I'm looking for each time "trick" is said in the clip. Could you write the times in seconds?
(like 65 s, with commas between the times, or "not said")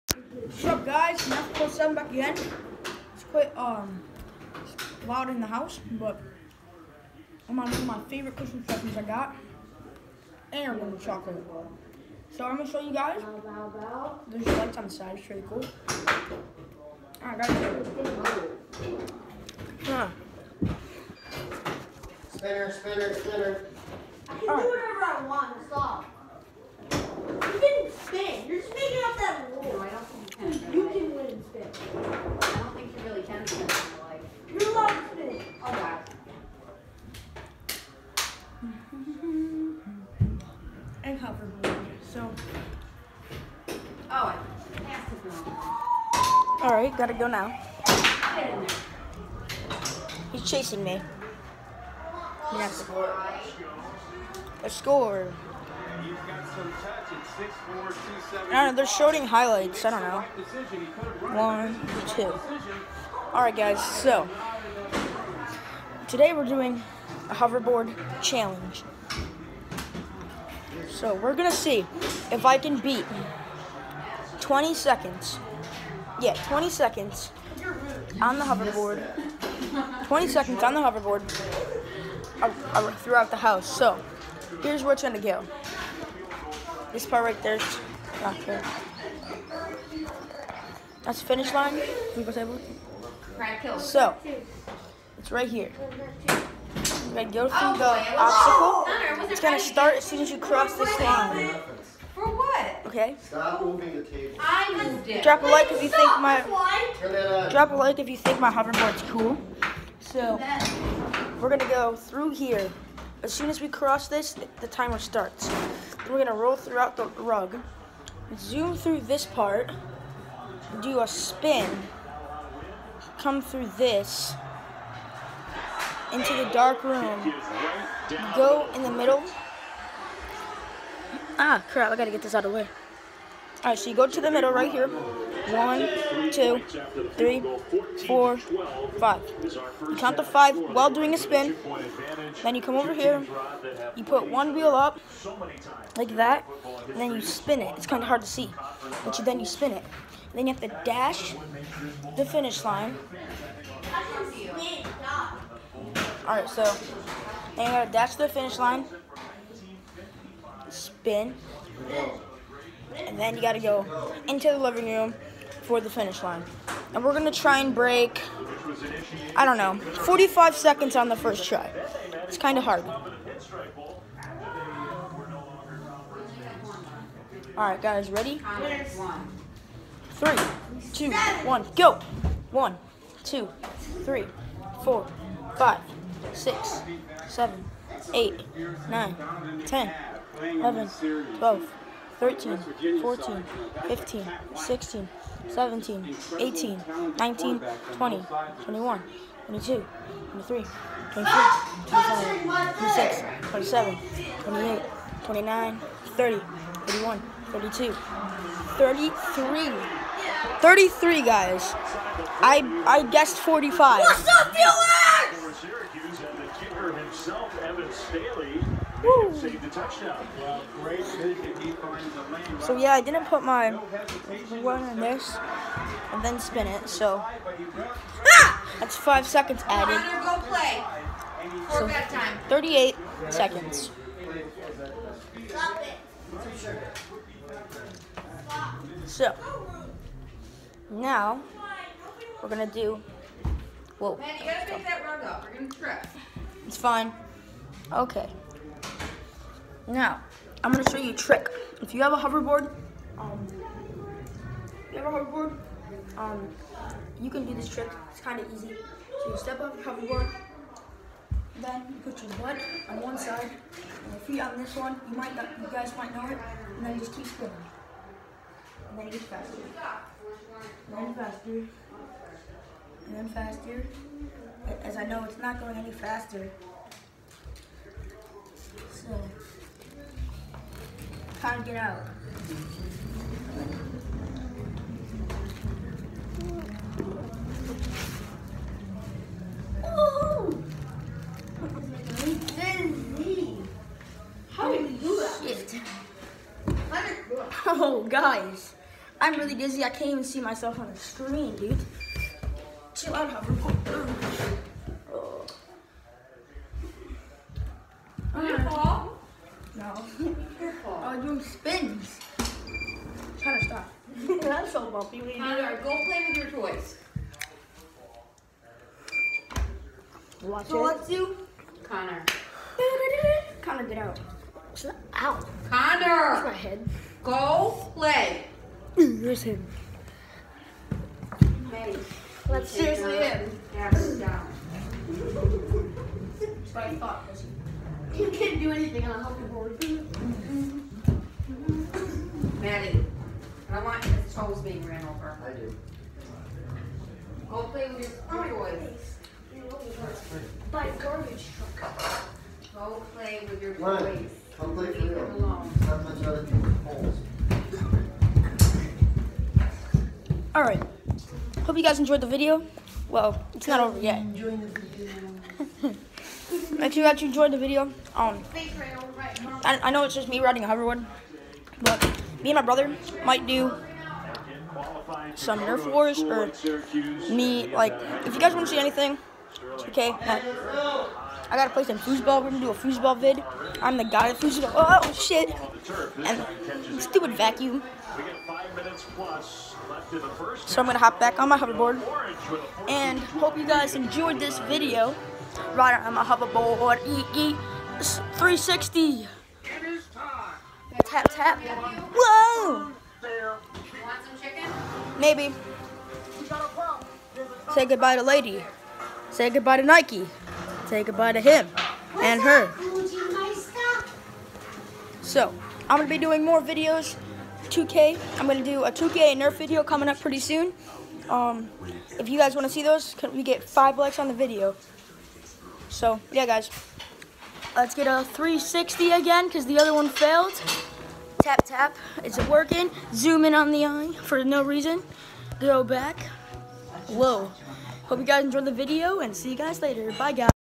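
251 s, 257 s.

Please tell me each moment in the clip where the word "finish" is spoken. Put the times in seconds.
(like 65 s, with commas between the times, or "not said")
91 s, 152 s, 158 s, 165 s.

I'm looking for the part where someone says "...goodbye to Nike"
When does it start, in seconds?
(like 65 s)
409 s.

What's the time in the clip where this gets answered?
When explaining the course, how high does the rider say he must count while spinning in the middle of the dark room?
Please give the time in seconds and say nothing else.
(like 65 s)
134 s.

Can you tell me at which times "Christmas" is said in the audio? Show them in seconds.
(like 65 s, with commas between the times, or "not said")
8 s.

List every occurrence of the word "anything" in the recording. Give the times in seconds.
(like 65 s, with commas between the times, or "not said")
338 s, 378 s.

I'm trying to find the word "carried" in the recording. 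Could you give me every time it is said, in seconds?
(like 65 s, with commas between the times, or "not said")
not said.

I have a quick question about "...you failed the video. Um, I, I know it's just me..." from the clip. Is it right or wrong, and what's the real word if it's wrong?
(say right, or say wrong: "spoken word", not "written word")
wrong: "enjoyed", not "failed".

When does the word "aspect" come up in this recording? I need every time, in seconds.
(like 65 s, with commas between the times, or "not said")
not said.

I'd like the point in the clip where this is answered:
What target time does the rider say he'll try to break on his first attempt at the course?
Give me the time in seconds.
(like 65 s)
170 s.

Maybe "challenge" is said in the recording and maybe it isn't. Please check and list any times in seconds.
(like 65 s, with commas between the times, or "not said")
68 s.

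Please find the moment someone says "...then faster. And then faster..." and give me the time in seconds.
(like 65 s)
270 s.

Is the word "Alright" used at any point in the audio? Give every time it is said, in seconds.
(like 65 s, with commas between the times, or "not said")
17 s, 63 s, 133 s, 360 s.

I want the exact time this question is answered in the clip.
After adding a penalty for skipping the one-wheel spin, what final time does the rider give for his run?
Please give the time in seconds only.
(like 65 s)
232 s.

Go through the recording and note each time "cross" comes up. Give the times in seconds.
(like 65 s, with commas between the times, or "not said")
100 s, 113 s.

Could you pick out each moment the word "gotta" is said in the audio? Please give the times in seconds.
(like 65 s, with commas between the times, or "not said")
46 s, 131 s, 157 s, 163 s, 244 s, 381 s.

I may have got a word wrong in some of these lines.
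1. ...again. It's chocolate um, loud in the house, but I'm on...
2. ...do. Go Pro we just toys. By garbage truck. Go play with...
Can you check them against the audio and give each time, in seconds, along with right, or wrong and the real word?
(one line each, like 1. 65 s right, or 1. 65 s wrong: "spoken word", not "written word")
1. 2 s wrong: "quite", not "chocolate"
2. 345 s wrong: "Hopefully", not "Pro".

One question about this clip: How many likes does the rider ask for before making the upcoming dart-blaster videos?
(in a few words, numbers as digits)
5.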